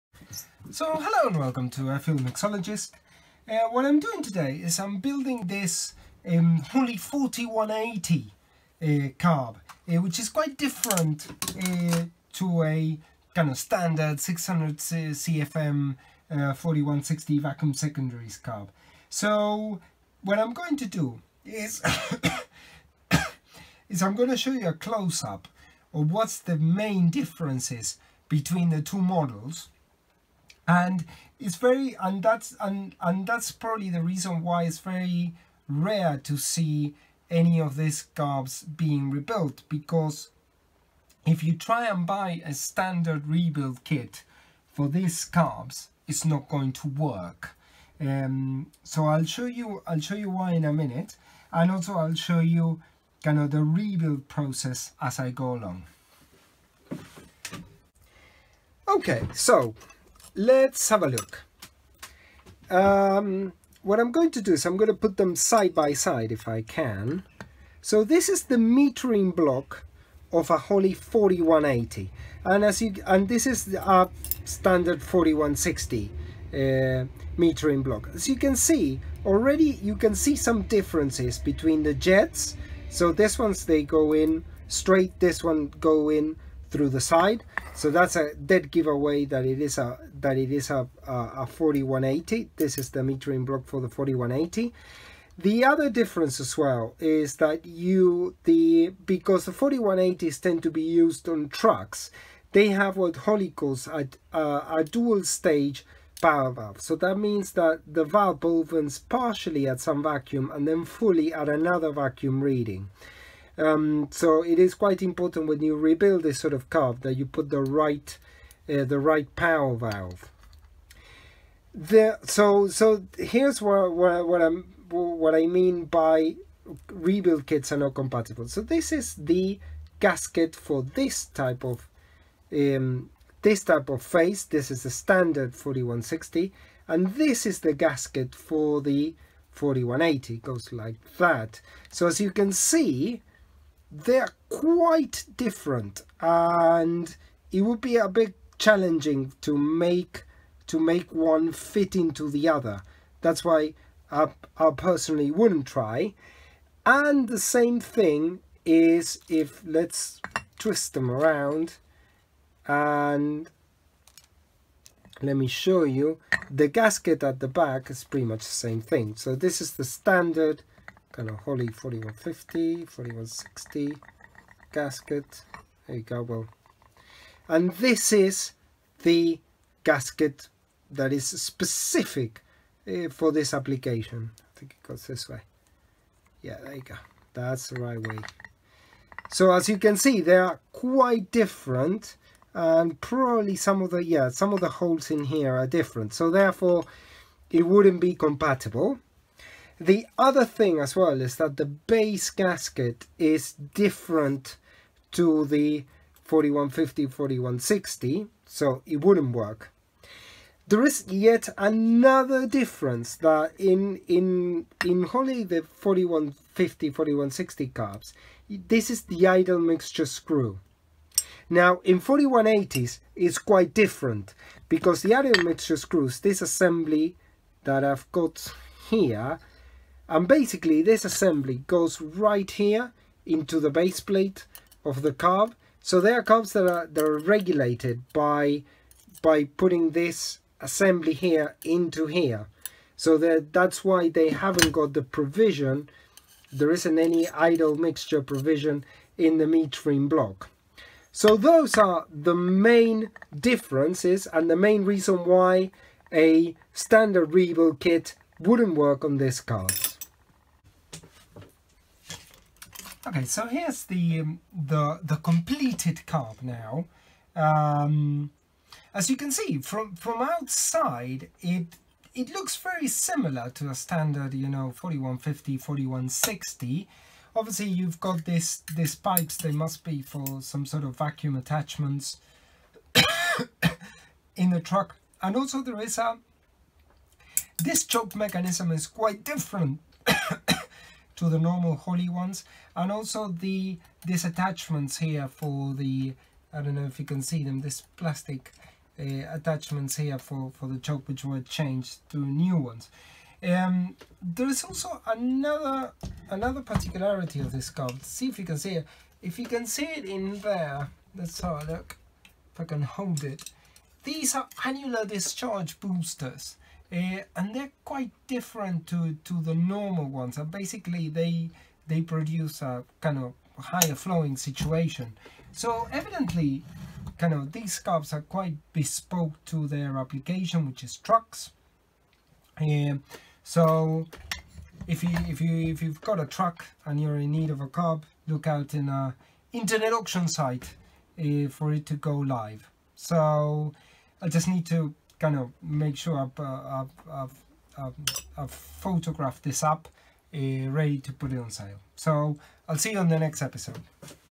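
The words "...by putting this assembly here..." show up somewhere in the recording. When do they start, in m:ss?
3:59.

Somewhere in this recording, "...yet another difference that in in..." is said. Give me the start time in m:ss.
3:31.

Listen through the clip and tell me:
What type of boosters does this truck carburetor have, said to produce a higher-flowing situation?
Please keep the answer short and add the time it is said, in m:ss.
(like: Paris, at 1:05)
annular discharge boosters, at 5:14.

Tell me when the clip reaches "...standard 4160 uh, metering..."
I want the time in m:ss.
1:14.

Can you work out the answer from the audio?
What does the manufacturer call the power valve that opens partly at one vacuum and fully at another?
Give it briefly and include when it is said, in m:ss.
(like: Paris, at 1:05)
dual stage power valve, at 1:44.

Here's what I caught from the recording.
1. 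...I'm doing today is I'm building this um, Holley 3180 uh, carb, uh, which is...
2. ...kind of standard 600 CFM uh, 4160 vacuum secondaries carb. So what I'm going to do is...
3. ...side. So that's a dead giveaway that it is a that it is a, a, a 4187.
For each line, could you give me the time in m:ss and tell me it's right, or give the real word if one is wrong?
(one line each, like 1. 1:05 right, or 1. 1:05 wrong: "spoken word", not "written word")
1. 0:03 wrong: "4180", not "3180"
2. 0:13 right
3. 1:27 wrong: "4180", not "4187".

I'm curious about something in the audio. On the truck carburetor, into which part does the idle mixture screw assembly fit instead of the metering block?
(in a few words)
the base plate.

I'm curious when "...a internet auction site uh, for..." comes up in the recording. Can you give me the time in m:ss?
5:38.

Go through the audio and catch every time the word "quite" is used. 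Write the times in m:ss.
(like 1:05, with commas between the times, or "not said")
0:10, 1:54, 2:24, 3:10, 3:43, 4:48, 5:17, 5:28.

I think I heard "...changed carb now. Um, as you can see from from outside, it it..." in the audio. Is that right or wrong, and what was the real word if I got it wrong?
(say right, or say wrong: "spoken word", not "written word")
wrong: "completed", not "changed".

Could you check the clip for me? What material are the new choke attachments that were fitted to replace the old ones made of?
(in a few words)
plastic.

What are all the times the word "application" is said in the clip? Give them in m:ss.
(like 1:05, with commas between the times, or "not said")
3:03, 5:29.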